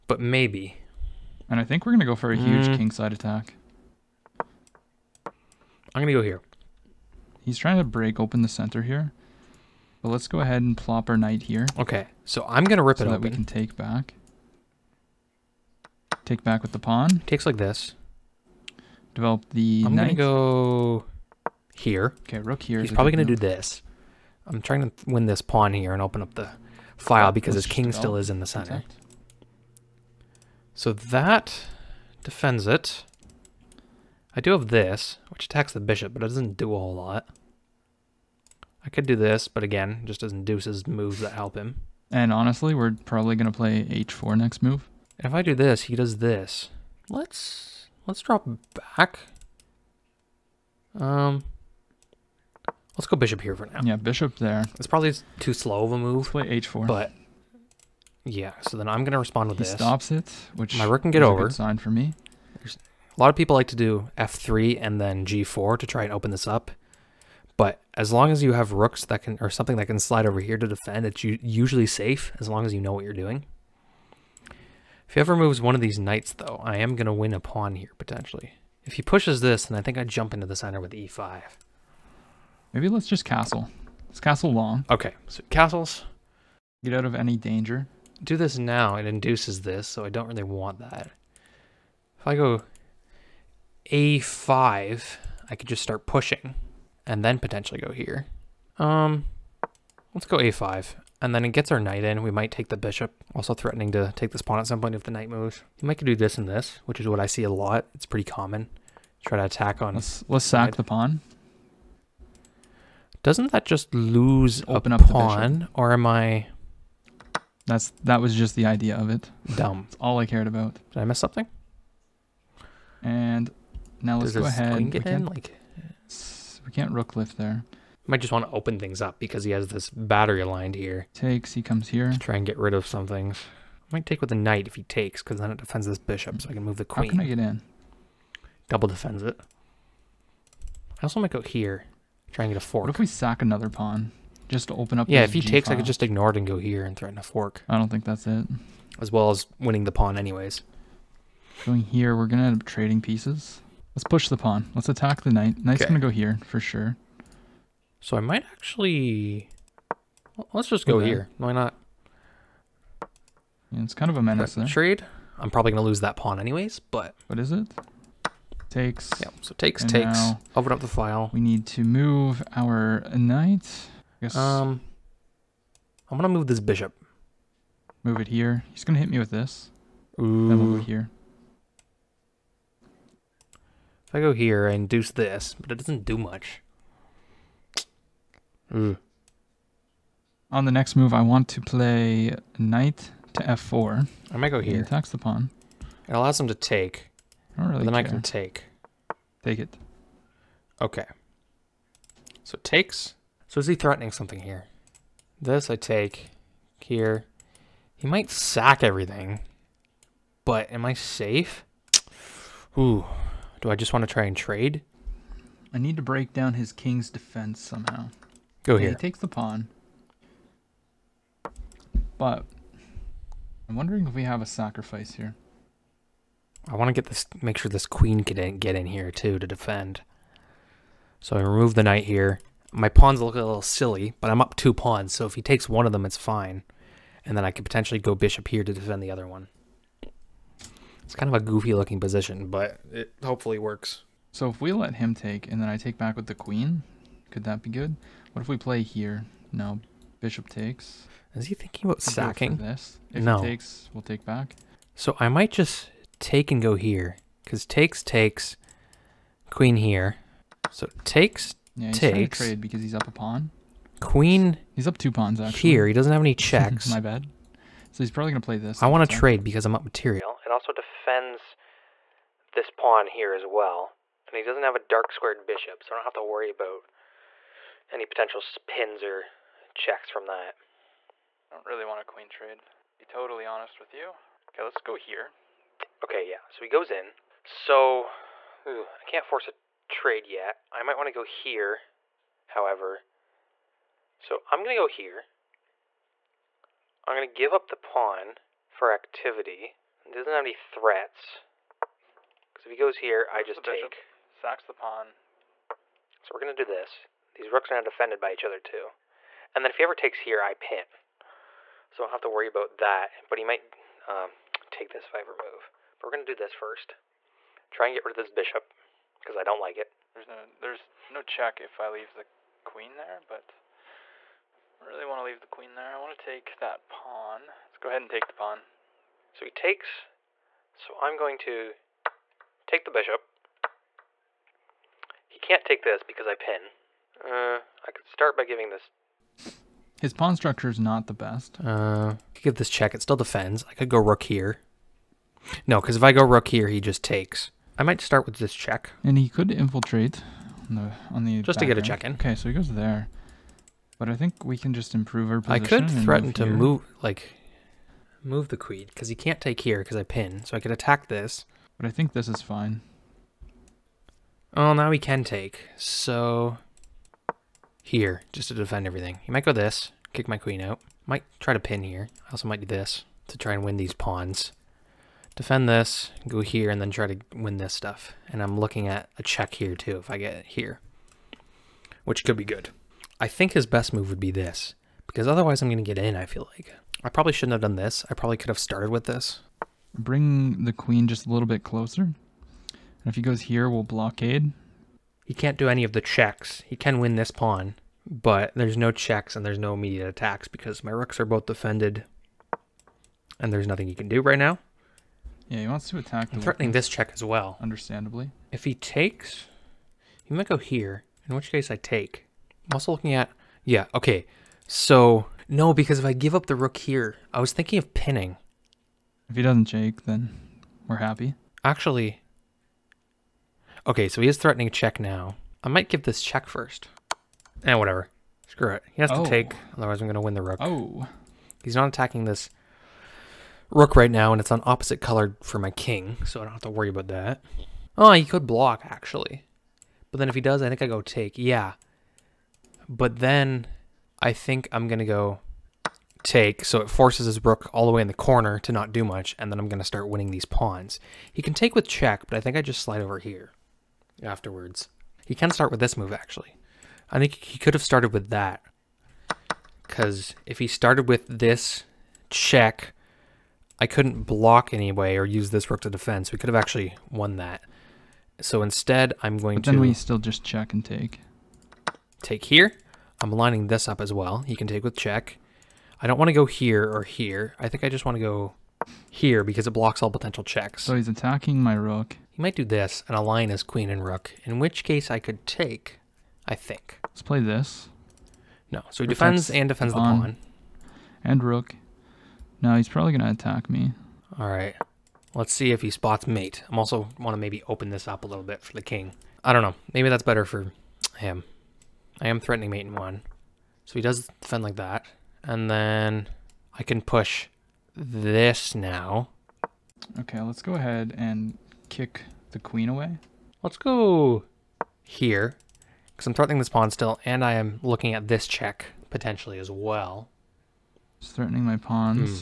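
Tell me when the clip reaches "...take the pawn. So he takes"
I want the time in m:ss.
5:28.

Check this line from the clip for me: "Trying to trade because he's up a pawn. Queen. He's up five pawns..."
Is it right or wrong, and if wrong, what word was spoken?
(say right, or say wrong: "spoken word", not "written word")
wrong: "two", not "five".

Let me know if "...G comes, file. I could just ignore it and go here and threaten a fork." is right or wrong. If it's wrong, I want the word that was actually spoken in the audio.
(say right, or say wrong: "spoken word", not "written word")
wrong: "takes", not "comes".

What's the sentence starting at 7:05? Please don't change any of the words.
I might give this check first.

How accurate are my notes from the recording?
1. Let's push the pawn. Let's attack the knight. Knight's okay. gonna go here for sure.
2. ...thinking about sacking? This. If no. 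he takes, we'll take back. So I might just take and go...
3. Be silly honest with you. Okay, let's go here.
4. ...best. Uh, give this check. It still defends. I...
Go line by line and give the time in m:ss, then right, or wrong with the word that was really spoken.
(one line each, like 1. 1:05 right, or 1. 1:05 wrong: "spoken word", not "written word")
1. 2:33 right
2. 4:11 right
3. 4:42 wrong: "totally", not "silly"
4. 5:41 right.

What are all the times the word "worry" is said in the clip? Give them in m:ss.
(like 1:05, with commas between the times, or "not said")
4:36, 5:12, 7:16.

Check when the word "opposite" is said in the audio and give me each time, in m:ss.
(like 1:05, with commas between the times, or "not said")
7:14.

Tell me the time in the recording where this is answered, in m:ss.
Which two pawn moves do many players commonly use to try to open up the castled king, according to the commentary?
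1:04.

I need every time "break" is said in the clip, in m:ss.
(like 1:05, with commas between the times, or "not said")
0:07, 3:36.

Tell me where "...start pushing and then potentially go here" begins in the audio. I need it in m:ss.
1:35.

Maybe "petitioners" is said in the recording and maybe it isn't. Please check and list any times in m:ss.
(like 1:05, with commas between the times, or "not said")
not said.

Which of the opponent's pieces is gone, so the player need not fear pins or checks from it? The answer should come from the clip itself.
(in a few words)
Dark squared bishop.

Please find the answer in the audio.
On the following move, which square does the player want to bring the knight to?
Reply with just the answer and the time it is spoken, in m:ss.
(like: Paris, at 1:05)
f4, at 3:12.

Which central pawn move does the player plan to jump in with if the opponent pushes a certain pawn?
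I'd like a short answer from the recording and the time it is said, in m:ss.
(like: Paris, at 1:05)
e5, at 1:20.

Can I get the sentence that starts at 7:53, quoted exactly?
I'm lining this up as well.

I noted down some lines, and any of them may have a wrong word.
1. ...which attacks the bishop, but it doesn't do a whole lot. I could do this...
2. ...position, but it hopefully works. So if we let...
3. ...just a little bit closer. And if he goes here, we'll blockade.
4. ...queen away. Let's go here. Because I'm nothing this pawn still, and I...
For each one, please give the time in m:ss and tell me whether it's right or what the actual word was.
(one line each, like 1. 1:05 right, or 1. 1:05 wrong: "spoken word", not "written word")
1. 0:35 right
2. 4:02 right
3. 6:31 right
4. 8:32 wrong: "threatening", not "nothing".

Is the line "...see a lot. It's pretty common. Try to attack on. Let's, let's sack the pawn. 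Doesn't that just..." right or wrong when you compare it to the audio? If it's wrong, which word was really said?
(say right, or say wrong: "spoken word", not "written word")
right.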